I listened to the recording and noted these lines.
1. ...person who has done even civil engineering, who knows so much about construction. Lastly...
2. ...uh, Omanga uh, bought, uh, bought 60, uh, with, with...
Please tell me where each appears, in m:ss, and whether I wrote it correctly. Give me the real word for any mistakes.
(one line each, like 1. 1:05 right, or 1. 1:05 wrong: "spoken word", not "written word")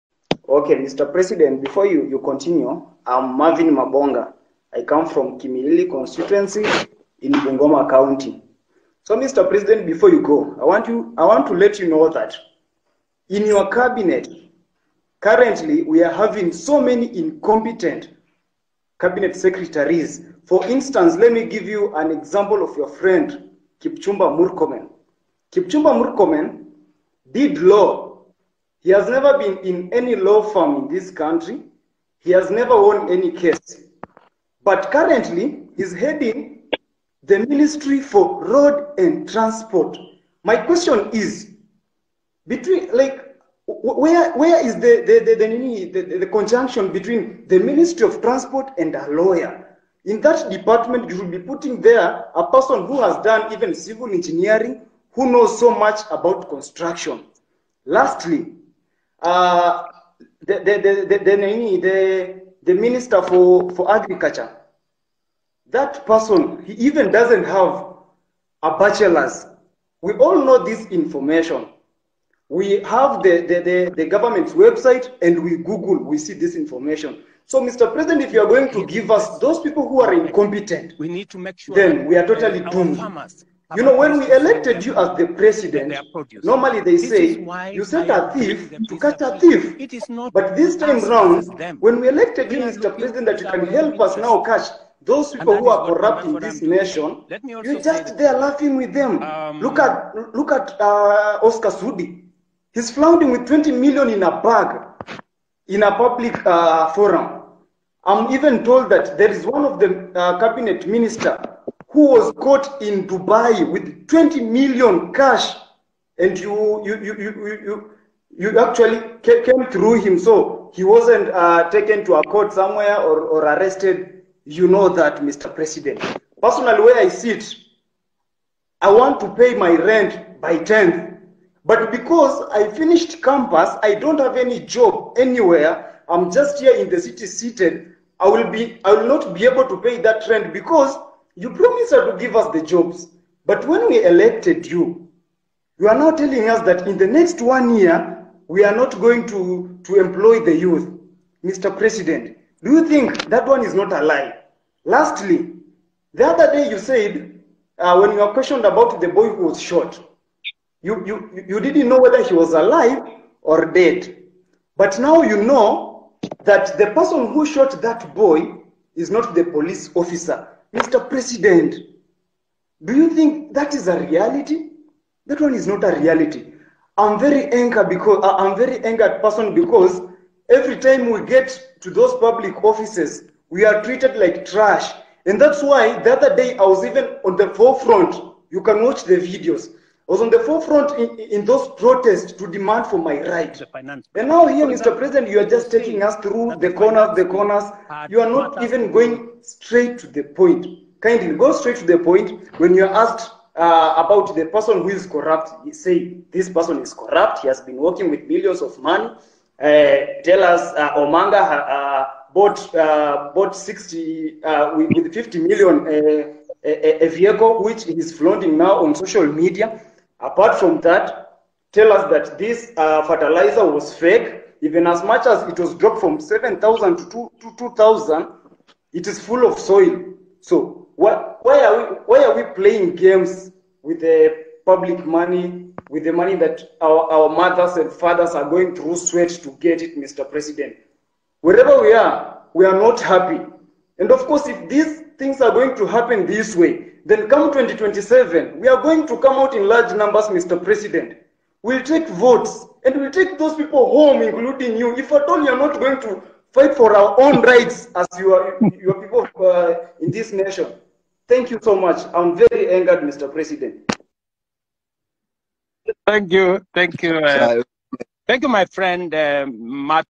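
1. 0:52 right
2. 3:30 right.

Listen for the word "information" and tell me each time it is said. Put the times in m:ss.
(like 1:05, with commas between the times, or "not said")
1:10, 1:16.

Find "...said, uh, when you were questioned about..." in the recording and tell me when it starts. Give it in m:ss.
2:36.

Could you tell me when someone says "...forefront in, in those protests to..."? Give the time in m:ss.
3:10.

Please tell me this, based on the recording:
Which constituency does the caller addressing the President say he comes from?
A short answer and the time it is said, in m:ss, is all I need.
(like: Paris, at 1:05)
Kimilili, at 0:05.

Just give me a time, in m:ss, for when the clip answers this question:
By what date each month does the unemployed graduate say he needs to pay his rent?
2:10.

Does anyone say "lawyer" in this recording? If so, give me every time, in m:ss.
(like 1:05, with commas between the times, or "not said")
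0:49.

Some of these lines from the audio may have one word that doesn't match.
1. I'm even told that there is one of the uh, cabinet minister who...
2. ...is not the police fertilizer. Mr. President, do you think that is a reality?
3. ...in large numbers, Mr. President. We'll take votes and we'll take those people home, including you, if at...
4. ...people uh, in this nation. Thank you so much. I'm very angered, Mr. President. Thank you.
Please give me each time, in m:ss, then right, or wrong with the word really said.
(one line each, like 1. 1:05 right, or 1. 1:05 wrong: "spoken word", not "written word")
1. 1:48 right
2. 2:48 wrong: "officer", not "fertilizer"
3. 4:09 right
4. 4:19 right.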